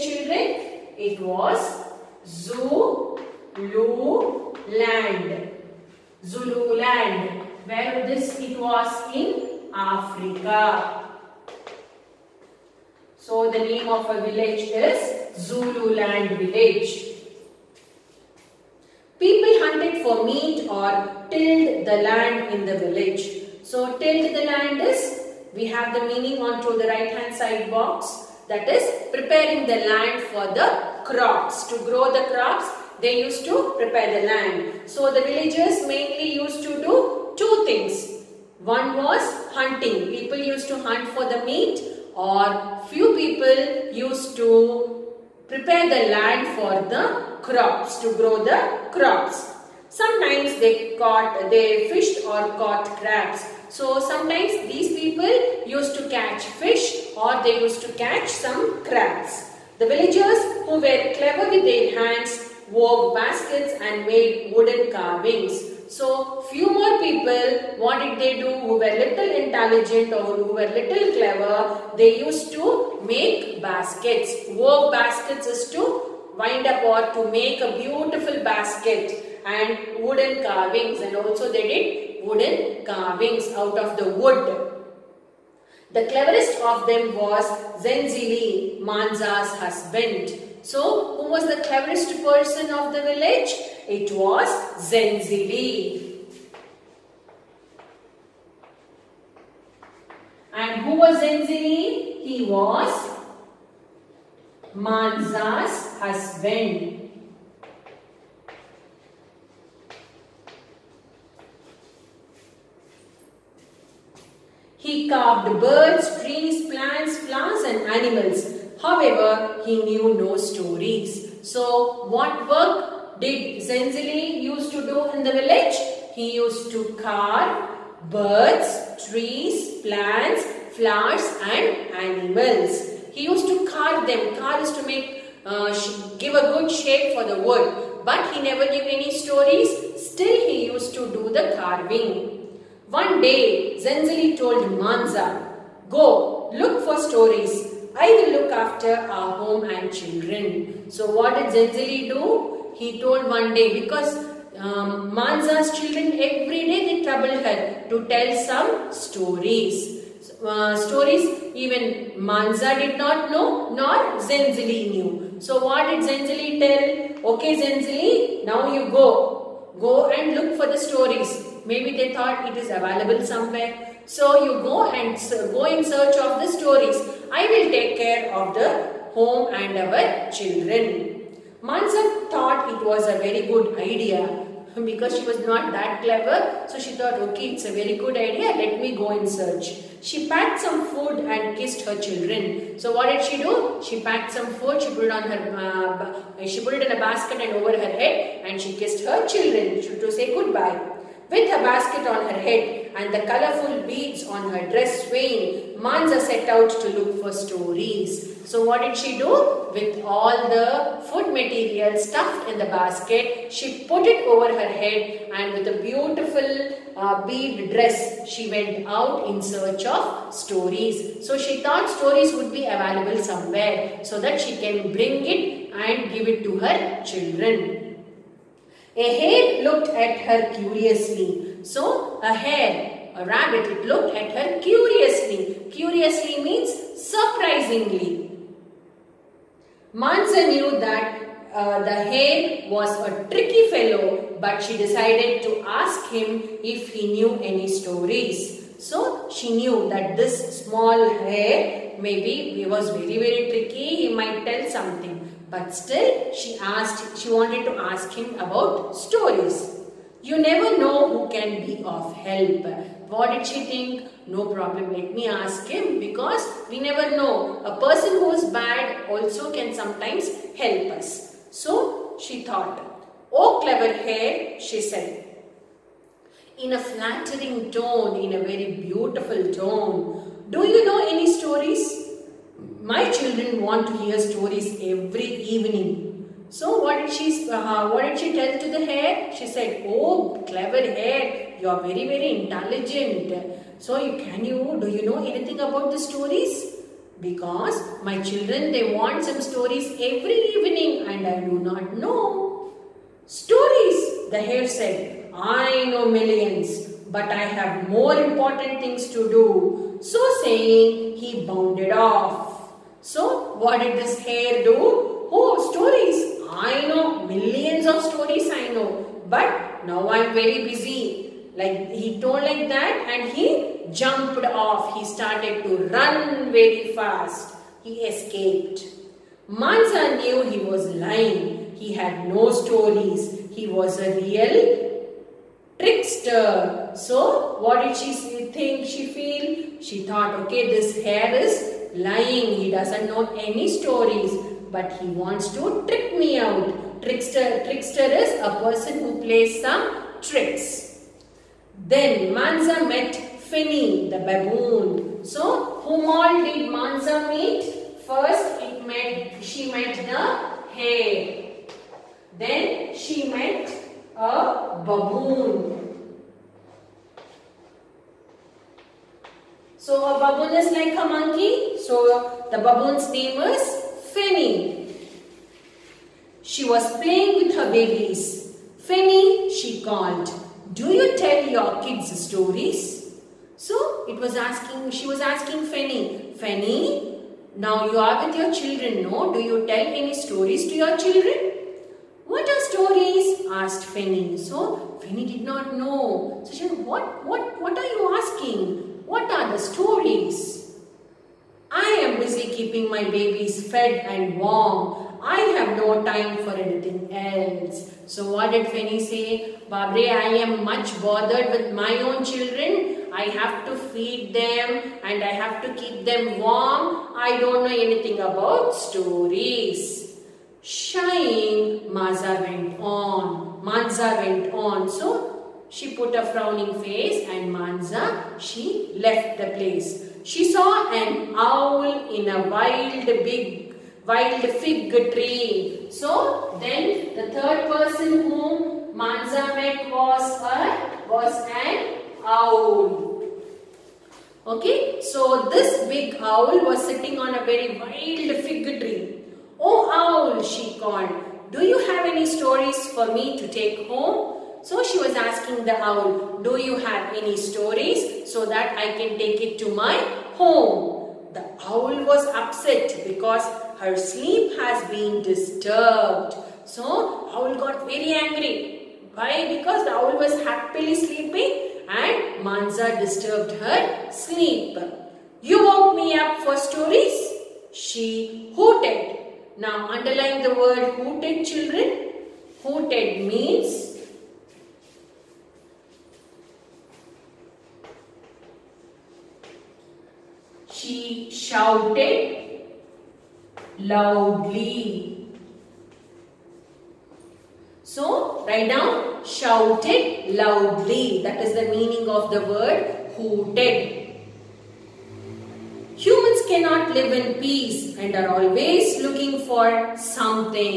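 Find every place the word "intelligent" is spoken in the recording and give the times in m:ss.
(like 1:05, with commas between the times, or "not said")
1:09, 4:52.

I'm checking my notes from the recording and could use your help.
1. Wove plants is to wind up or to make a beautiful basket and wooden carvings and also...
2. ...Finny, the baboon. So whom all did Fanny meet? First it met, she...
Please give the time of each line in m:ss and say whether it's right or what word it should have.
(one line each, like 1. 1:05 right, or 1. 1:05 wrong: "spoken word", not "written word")
1. 1:14 wrong: "baskets", not "plants"
2. 5:53 wrong: "Manza", not "Fanny".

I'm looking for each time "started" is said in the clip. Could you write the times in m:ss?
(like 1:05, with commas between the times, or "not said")
5:25.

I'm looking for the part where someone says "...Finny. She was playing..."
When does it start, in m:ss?
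6:14.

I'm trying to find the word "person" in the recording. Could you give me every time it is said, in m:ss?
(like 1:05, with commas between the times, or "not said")
1:32, 4:27, 5:48, 7:17.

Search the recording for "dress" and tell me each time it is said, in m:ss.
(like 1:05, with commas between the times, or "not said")
3:24, 3:37.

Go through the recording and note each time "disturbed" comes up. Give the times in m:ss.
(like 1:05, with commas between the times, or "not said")
7:45, 7:53.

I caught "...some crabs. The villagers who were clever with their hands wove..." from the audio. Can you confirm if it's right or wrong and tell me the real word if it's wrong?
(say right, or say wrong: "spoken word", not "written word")
right.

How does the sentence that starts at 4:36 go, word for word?
In a flattering tone, in a very beautiful tone.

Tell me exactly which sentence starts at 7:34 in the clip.
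So she was asking the owl, do you have any stories so that I can take it to my home?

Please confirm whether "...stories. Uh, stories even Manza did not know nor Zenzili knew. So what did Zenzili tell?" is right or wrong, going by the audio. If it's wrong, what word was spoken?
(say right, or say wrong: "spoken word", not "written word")
right.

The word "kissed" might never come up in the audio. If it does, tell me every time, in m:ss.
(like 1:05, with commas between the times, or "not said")
3:11, 3:18.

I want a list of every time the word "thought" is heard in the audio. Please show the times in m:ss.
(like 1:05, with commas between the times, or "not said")
2:52, 3:02, 3:06, 3:41, 4:32, 5:40.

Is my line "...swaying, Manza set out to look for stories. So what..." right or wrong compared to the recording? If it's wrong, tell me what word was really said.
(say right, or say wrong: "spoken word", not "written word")
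right.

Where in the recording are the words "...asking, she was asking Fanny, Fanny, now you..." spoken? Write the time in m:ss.
6:24.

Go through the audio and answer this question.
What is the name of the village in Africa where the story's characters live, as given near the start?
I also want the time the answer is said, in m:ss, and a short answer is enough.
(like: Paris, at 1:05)
Zululand village, at 0:15.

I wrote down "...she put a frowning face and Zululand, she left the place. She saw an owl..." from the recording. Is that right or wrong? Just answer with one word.
wrong.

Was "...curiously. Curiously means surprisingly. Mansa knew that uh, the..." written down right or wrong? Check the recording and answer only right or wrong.
right.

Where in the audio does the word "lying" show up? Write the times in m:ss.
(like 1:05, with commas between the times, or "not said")
5:30, 5:41.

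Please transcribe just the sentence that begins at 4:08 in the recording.
So she knew that this small hare maybe he was very very tricky, he might tell something.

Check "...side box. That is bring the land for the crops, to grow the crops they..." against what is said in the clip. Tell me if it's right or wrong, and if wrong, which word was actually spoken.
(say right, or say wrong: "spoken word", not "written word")
wrong: "preparing", not "bring".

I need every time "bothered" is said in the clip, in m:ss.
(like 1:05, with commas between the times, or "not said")
6:51.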